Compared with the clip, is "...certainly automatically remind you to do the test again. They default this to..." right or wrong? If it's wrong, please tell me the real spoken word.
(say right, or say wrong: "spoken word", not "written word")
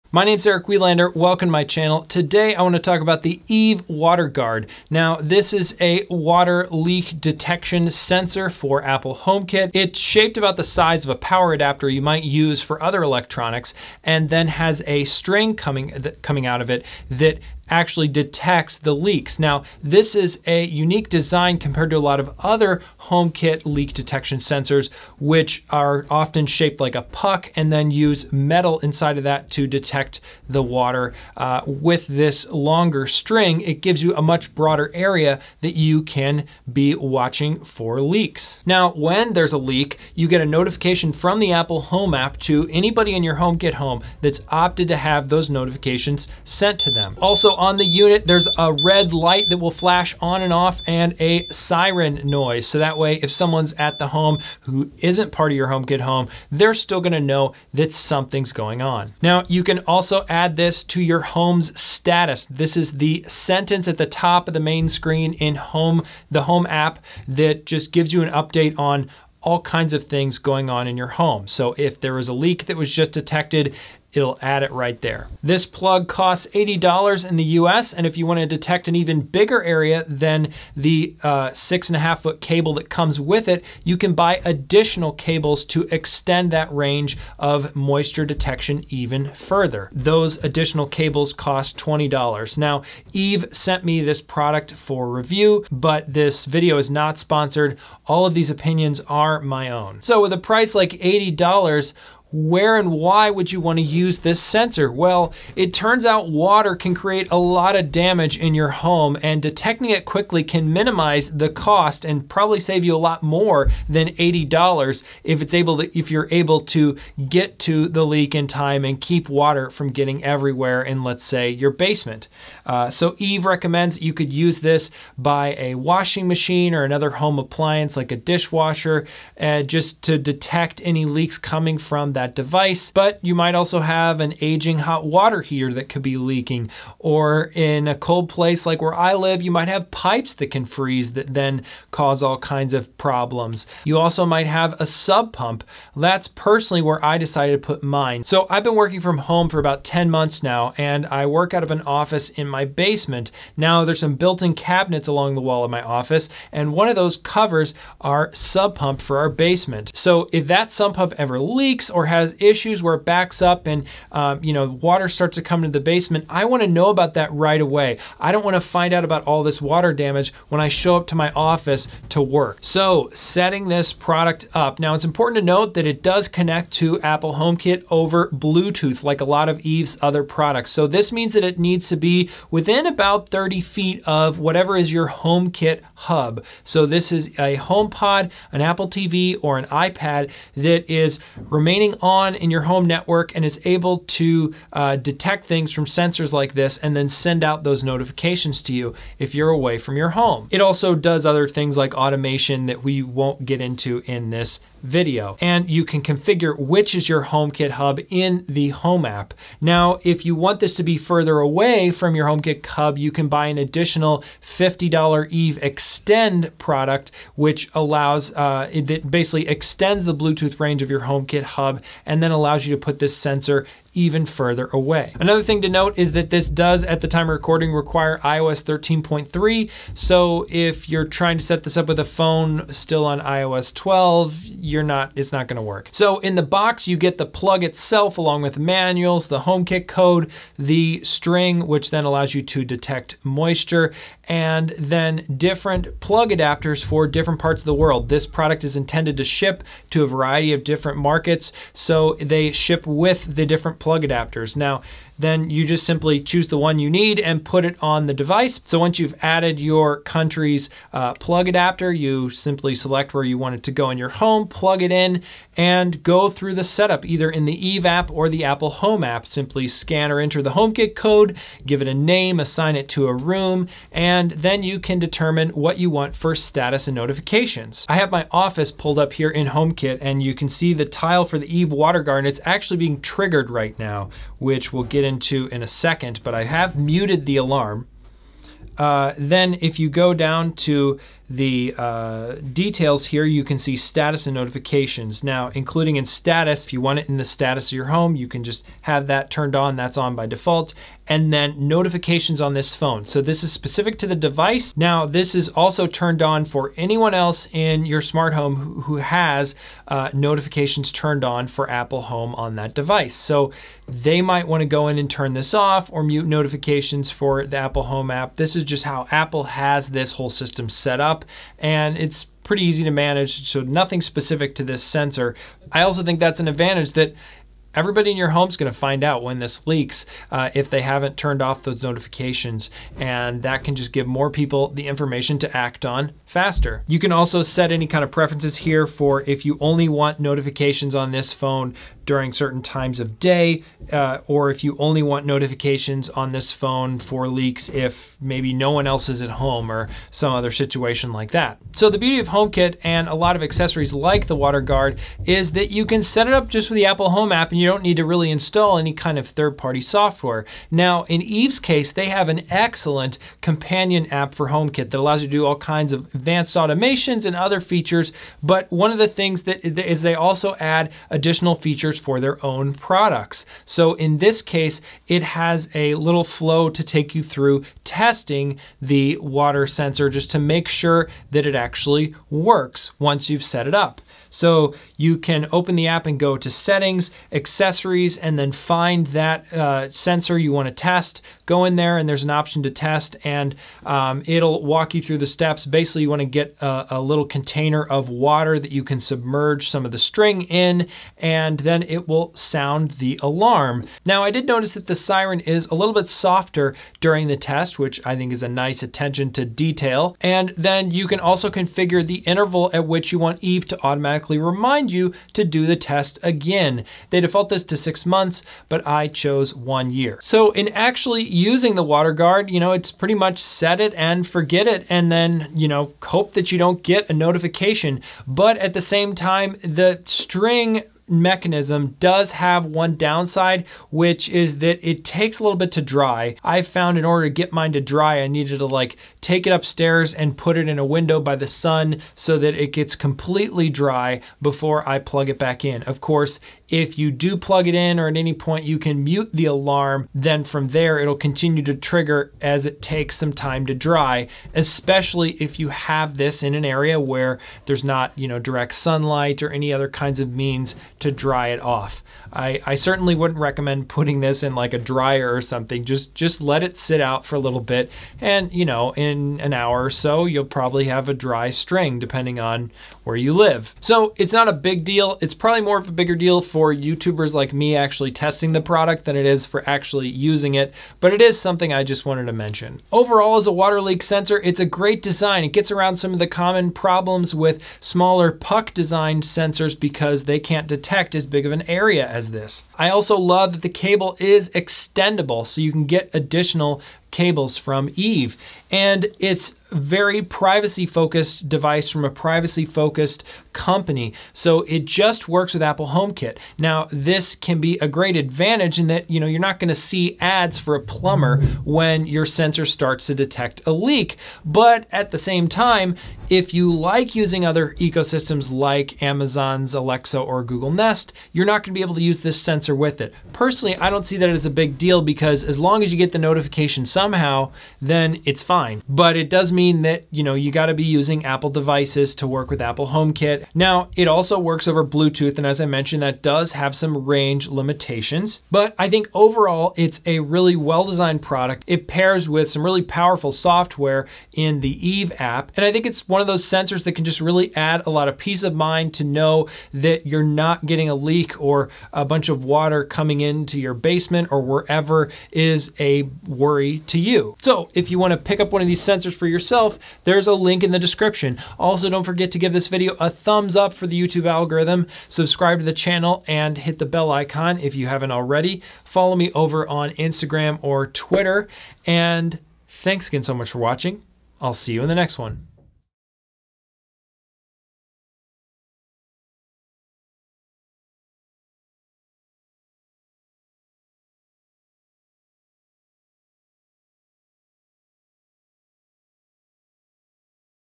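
wrong: "automatically", not "certainly".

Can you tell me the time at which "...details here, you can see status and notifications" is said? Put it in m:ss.
4:52.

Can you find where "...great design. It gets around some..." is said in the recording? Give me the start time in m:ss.
8:04.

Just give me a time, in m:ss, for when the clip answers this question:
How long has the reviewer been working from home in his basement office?
2:29.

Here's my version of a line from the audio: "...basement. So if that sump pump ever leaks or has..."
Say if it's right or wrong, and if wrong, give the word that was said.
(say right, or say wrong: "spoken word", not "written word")
right.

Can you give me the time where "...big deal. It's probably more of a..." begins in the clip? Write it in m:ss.
7:54.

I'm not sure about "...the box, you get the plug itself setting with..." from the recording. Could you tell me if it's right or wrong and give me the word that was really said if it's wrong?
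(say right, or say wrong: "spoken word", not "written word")
wrong: "along", not "setting".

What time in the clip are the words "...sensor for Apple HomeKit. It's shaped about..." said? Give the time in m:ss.
0:07.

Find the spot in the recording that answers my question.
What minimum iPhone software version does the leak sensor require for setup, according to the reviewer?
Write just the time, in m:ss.
3:48.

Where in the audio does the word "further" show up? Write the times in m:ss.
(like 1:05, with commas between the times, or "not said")
1:29, 3:30, 3:44.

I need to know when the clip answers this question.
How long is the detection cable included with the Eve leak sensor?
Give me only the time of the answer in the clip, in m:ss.
1:21.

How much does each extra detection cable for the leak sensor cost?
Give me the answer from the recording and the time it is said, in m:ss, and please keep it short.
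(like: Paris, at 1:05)
$20, at 1:31.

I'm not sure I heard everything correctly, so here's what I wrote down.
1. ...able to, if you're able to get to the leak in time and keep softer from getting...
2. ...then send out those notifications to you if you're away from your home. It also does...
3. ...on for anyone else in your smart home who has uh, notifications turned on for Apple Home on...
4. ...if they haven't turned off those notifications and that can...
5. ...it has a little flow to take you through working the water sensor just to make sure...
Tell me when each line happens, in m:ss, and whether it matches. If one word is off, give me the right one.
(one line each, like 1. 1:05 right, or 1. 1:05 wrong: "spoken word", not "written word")
1. 1:55 wrong: "water", not "softer"
2. 3:16 right
3. 5:06 right
4. 5:30 right
5. 6:15 wrong: "testing", not "working".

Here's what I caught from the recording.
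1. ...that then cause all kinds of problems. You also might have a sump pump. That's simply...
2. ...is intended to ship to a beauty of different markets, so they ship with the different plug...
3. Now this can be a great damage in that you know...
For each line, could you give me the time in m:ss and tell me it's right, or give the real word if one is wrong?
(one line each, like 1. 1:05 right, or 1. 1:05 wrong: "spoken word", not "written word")
1. 2:21 wrong: "personally", not "simply"
2. 4:08 wrong: "variety", not "beauty"
3. 8:26 wrong: "advantage", not "damage".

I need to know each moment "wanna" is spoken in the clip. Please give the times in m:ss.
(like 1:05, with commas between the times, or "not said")
0:02, 1:18, 6:30, 6:36, 9:17.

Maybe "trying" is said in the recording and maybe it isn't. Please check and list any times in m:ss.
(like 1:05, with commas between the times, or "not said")
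3:51.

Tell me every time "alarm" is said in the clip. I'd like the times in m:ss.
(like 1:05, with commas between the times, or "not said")
4:47, 6:43, 7:29.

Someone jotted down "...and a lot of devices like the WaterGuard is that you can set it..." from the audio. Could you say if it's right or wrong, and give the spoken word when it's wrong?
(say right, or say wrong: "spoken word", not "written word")
wrong: "accessories", not "devices".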